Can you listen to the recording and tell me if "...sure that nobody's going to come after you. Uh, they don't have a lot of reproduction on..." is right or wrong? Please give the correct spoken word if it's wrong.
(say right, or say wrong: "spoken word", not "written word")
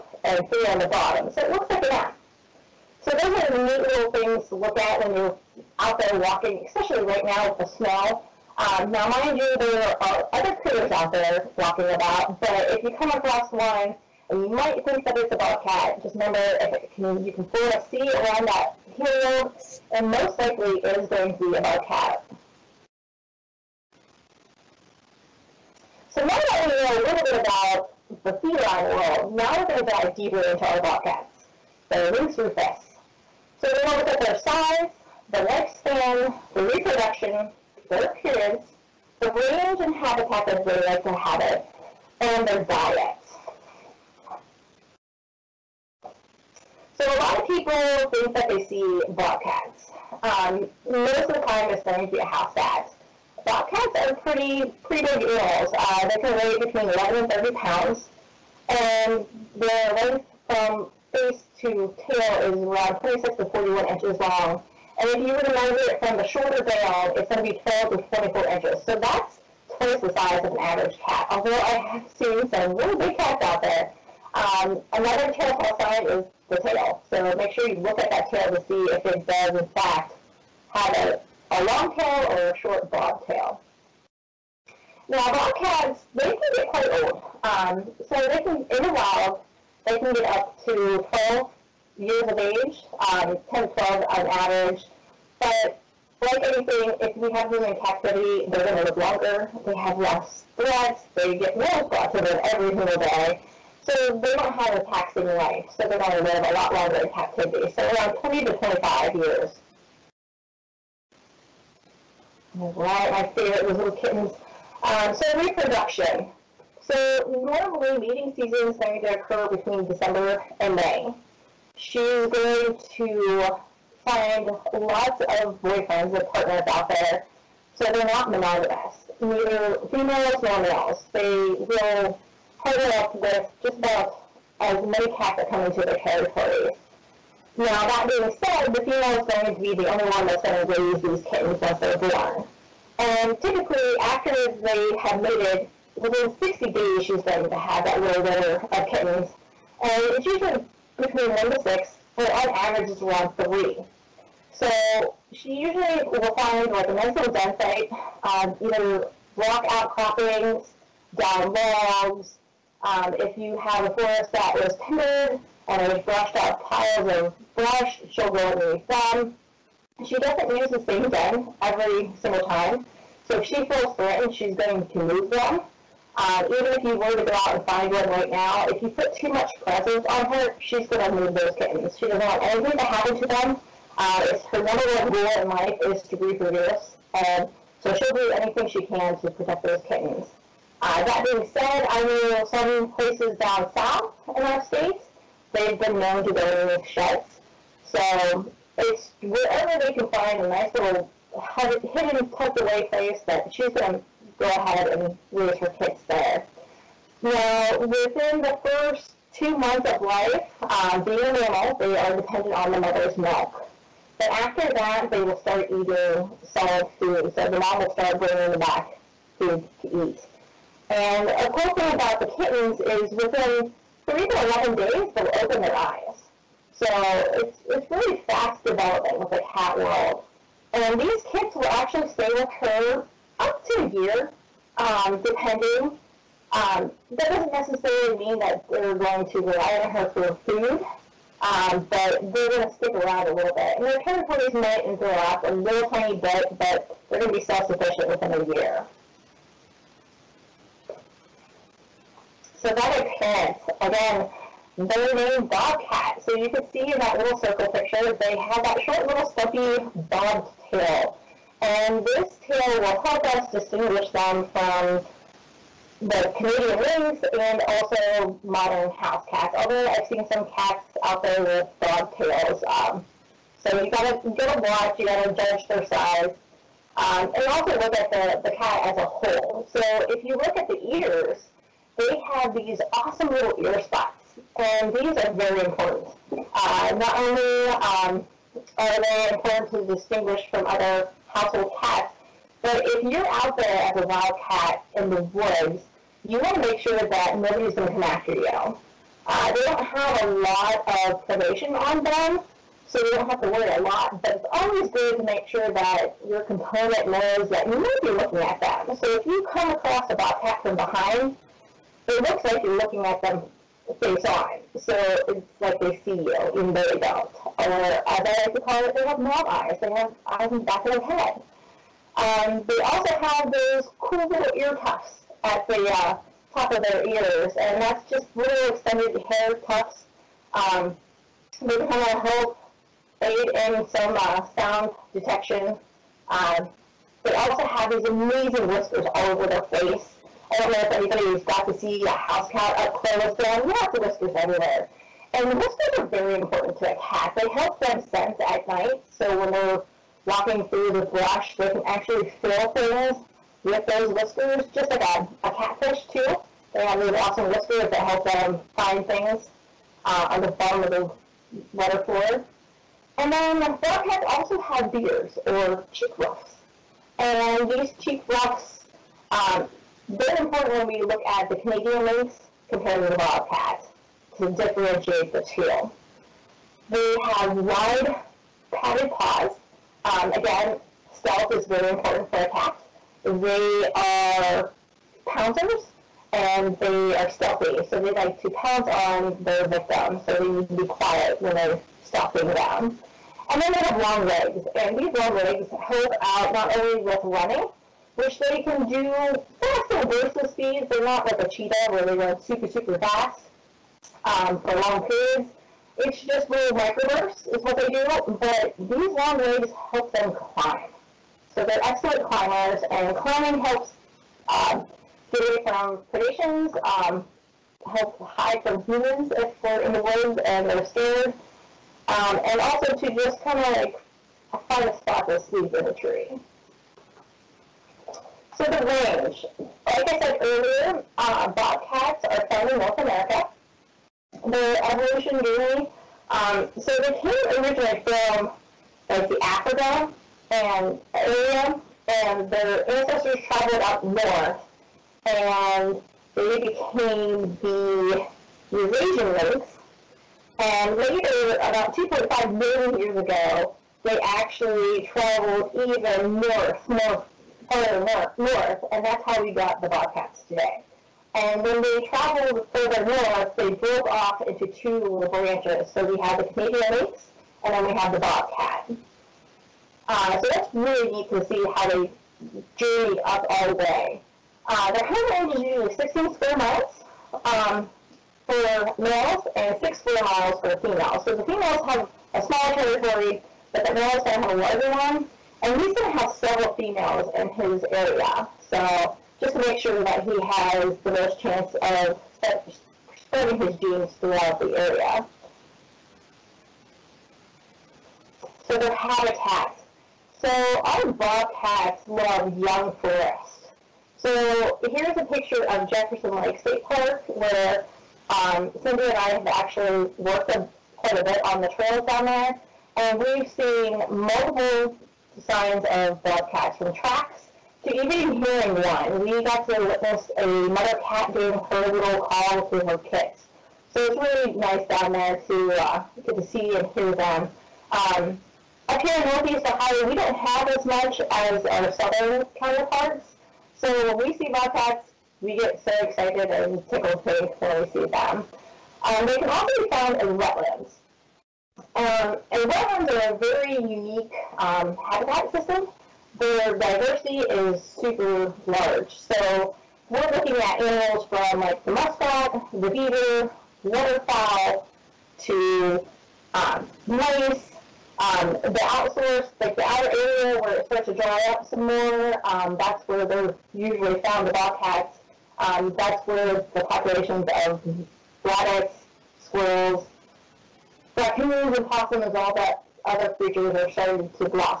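wrong: "predation", not "reproduction".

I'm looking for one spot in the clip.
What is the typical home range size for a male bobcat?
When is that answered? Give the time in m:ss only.
7:55.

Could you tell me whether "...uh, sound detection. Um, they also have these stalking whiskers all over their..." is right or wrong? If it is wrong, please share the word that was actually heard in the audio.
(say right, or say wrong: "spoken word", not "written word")
wrong: "amazing", not "stalking".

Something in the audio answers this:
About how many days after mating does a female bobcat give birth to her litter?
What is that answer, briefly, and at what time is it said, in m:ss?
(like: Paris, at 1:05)
60 days, at 2:25.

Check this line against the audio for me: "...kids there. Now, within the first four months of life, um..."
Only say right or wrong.
wrong.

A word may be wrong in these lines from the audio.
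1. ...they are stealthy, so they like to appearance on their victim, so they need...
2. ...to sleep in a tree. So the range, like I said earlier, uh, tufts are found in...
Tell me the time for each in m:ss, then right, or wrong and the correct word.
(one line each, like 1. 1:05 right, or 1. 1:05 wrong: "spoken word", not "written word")
1. 6:26 wrong: "pounce", not "appearance"
2. 7:05 wrong: "bobcats", not "tufts".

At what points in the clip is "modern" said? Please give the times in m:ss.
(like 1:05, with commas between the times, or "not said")
4:28.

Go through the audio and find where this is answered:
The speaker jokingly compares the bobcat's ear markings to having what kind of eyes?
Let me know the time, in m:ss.
5:19.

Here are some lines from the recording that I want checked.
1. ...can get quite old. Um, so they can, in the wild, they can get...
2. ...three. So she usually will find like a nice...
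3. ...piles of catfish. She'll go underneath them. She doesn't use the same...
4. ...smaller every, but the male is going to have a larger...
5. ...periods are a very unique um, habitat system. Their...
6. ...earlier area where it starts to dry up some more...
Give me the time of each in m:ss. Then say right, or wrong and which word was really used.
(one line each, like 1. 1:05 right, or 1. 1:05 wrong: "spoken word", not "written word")
1. 1:26 right
2. 2:33 right
3. 2:46 wrong: "brush", not "catfish"
4. 8:02 wrong: "territory", not "every"
5. 9:02 wrong: "wetlands", not "periods"
6. 9:19 wrong: "outer", not "earlier".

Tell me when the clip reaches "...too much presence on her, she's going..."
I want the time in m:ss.
2:59.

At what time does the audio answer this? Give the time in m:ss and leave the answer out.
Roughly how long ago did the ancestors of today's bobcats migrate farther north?
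7:31.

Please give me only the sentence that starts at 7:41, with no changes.
And when they traveled further north, they broke off into two little branches.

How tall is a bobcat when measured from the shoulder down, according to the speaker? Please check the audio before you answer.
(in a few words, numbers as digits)
12 to 24 inches.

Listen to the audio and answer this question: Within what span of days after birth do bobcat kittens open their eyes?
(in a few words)
3 to 11 days.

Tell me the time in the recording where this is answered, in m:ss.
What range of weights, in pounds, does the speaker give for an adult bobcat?
0:56.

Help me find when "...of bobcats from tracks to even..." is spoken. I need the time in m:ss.
8:35.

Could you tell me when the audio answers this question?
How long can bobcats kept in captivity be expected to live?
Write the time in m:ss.
1:47.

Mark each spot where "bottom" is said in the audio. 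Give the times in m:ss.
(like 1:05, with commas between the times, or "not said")
0:00, 6:00.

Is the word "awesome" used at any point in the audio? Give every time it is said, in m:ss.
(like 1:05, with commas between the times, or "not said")
4:42, 5:57.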